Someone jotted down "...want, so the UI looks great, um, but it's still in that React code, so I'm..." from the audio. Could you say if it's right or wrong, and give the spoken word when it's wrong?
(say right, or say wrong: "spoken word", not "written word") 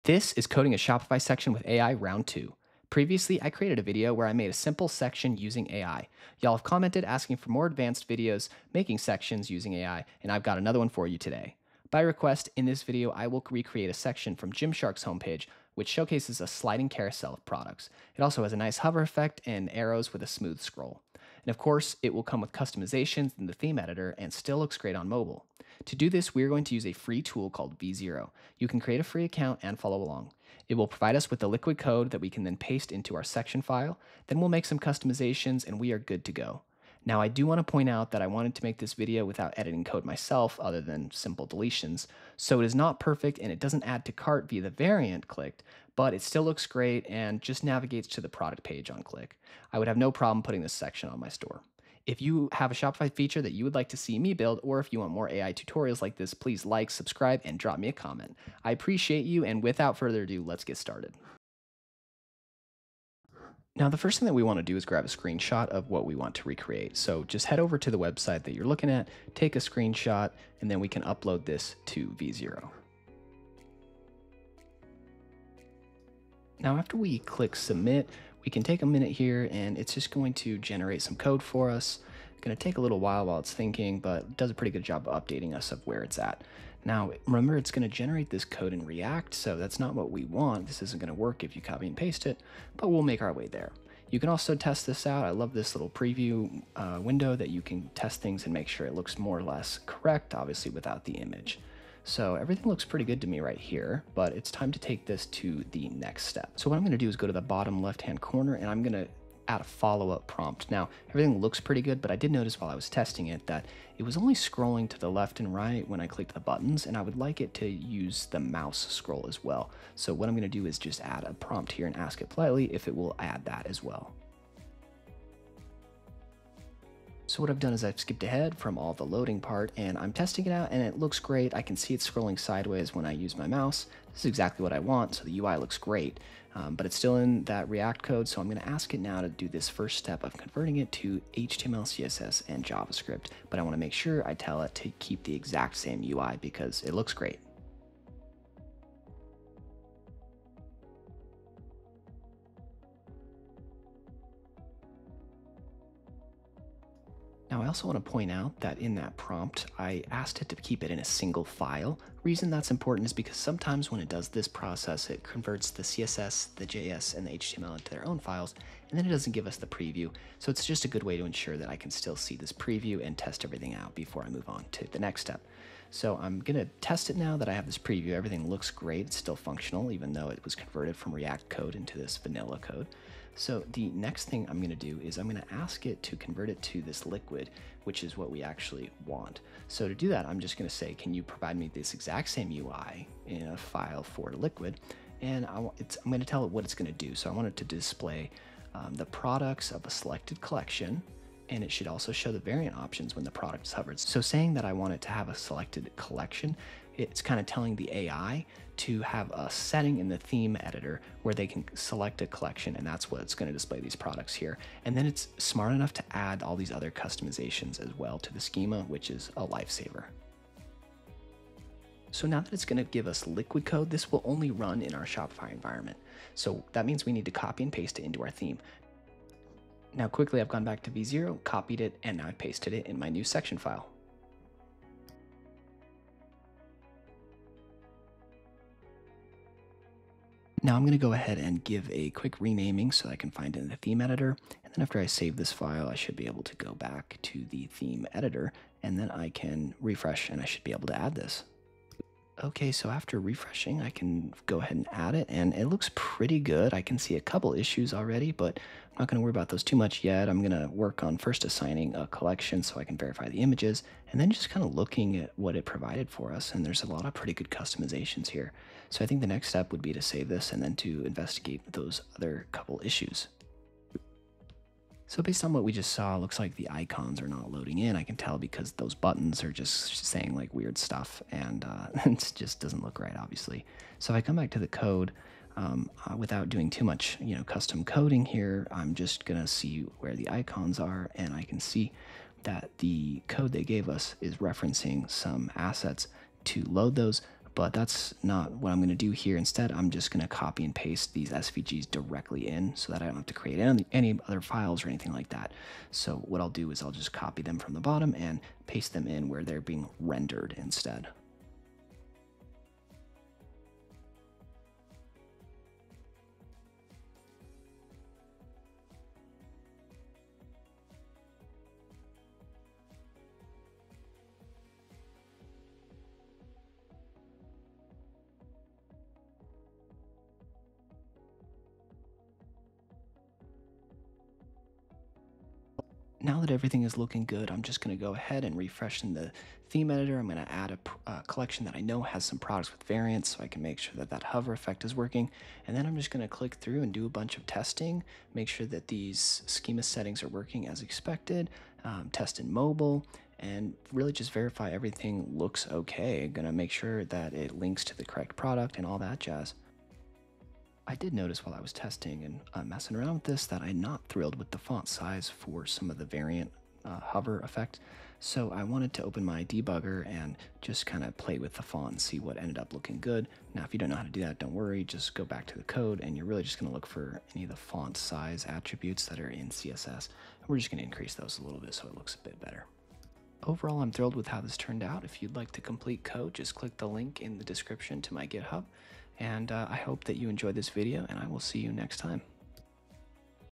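right.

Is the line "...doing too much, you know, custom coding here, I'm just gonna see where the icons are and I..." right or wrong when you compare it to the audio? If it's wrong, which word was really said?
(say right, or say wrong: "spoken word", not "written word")
right.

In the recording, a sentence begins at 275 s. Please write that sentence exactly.
So based on what we just saw, looks like the icons are not loading in.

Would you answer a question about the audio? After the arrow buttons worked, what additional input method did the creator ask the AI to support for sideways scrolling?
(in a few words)
mouse scroll.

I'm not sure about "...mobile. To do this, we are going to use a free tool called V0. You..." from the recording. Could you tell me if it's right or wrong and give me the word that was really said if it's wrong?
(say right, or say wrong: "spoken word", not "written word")
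right.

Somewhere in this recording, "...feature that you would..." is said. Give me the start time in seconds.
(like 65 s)
53 s.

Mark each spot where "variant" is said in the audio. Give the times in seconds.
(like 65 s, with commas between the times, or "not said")
44 s, 202 s, 342 s, 366 s.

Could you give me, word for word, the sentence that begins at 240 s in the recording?
Now I'm going to go ahead and give a quick renaming so I can find it in the theme editor.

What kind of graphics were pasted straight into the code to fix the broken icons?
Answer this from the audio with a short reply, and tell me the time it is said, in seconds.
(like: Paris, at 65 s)
SVGs, at 301 s.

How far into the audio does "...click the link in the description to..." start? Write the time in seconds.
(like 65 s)
386 s.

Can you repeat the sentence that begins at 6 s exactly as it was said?
Y'all have commented asking for more advanced videos making sections using AI, and I've got another one for you today.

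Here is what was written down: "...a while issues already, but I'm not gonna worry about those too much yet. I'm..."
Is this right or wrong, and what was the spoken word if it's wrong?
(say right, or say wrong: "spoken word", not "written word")
wrong: "couple", not "while".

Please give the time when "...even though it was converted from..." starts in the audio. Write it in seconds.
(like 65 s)
179 s.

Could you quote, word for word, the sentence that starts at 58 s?
I appreciate you, and without further ado, let's get started.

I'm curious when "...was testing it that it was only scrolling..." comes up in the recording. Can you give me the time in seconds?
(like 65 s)
112 s.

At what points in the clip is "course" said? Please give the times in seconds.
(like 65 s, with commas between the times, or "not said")
21 s.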